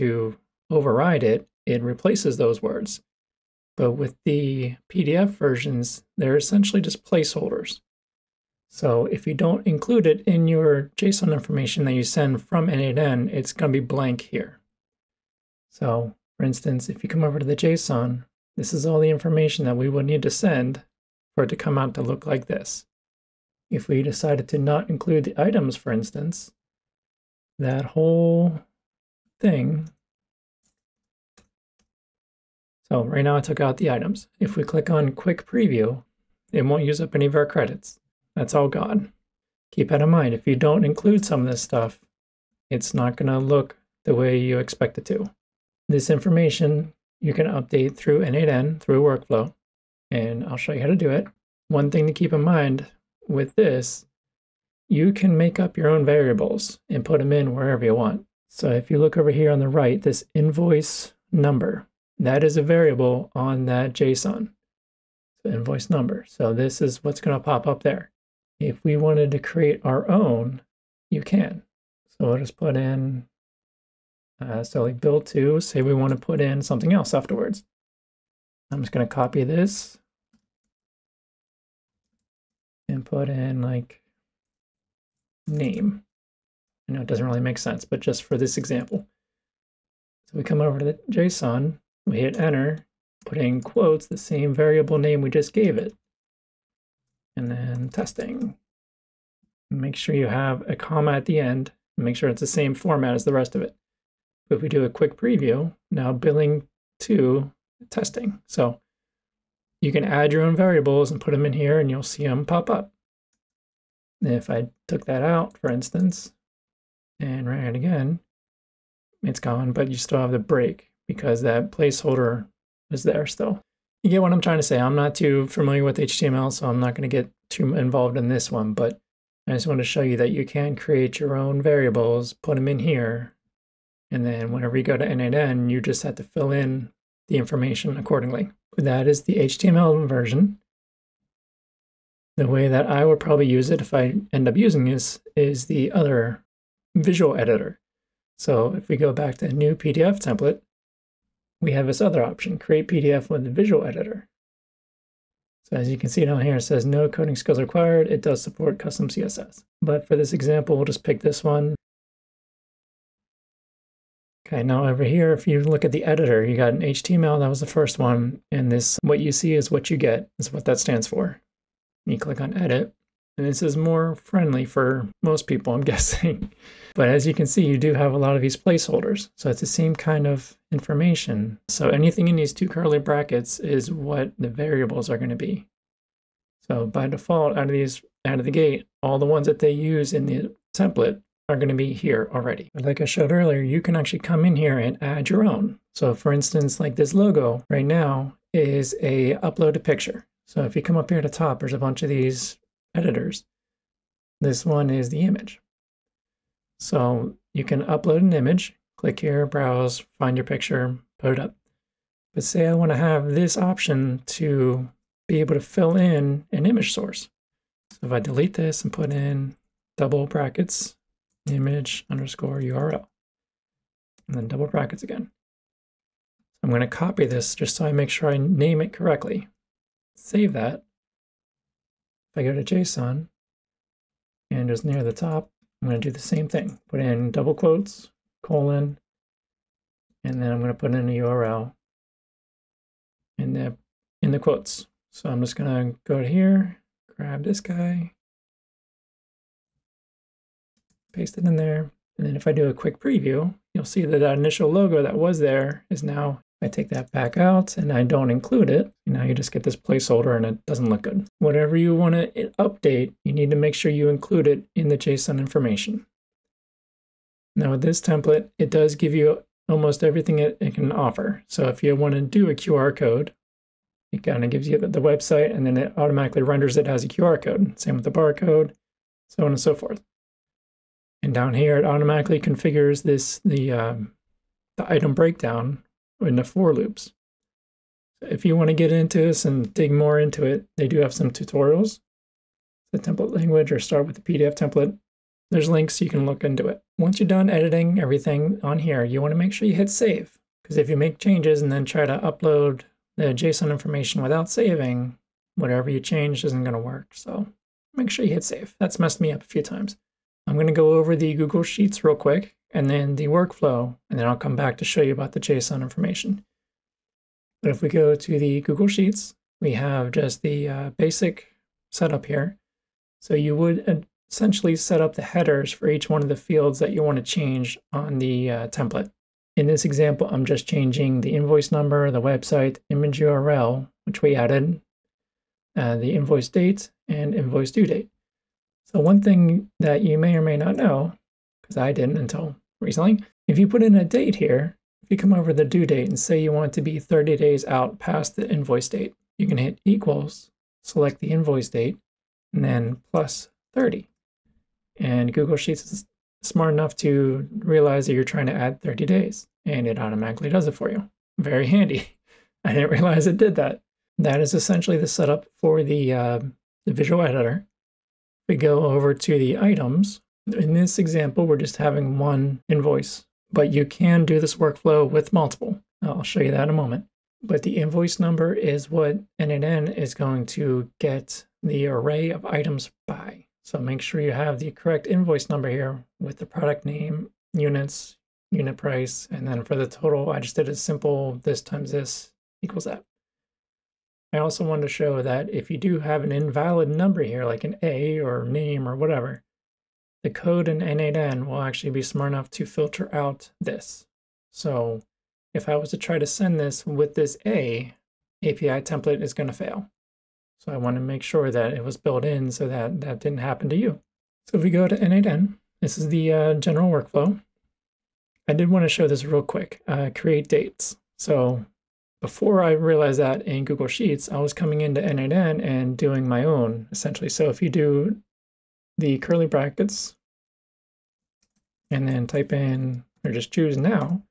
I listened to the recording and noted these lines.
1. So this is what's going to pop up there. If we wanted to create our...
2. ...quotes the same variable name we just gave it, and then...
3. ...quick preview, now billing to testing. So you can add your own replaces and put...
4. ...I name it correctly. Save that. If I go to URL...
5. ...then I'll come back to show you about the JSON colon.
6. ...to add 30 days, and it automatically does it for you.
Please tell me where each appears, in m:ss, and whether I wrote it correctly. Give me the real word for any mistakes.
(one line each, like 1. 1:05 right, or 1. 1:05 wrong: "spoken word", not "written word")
1. 1:06 right
2. 1:33 right
3. 1:44 wrong: "variables", not "replaces"
4. 3:48 wrong: "JSON", not "URL"
5. 5:14 wrong: "information", not "colon"
6. 5:58 right.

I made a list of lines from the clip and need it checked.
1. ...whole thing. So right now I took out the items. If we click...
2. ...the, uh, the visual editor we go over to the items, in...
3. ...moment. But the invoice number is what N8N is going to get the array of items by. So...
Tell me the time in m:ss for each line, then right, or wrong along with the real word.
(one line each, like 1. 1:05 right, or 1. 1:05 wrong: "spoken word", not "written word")
1. 0:27 right
2. 6:05 right
3. 6:16 right.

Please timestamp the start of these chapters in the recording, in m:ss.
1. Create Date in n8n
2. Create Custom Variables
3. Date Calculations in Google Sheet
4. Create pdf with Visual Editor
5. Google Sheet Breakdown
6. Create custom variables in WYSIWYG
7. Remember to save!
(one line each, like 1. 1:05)
1. 6:57
2. 1:07
3. 5:37
4. 2:30
5. 5:16
6. 3:11
7. 4:56.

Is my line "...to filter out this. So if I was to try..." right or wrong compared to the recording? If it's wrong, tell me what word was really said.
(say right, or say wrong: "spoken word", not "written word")
right.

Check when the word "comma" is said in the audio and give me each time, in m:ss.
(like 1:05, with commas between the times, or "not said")
1:40.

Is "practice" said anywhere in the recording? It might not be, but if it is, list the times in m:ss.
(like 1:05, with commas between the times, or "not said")
not said.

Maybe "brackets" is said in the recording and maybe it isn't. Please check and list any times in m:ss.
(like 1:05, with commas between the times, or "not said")
3:02, 3:40, 3:44, 7:09.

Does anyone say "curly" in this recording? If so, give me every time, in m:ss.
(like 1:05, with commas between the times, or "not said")
3:02, 7:09.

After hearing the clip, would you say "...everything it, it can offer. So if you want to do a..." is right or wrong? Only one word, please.
right.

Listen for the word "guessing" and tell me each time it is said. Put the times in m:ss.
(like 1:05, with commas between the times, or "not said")
2:55.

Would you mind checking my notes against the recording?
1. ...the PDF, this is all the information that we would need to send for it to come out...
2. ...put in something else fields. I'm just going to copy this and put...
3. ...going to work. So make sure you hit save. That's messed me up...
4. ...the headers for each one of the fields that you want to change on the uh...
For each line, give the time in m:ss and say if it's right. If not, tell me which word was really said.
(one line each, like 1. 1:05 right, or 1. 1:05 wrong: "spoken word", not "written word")
1. 0:17 wrong: "JSON", not "PDF"
2. 1:16 wrong: "afterwards", not "fields"
3. 5:06 right
4. 5:25 right.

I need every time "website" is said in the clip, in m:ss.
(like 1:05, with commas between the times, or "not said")
4:35, 5:32.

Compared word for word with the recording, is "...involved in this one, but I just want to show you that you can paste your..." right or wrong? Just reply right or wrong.
wrong.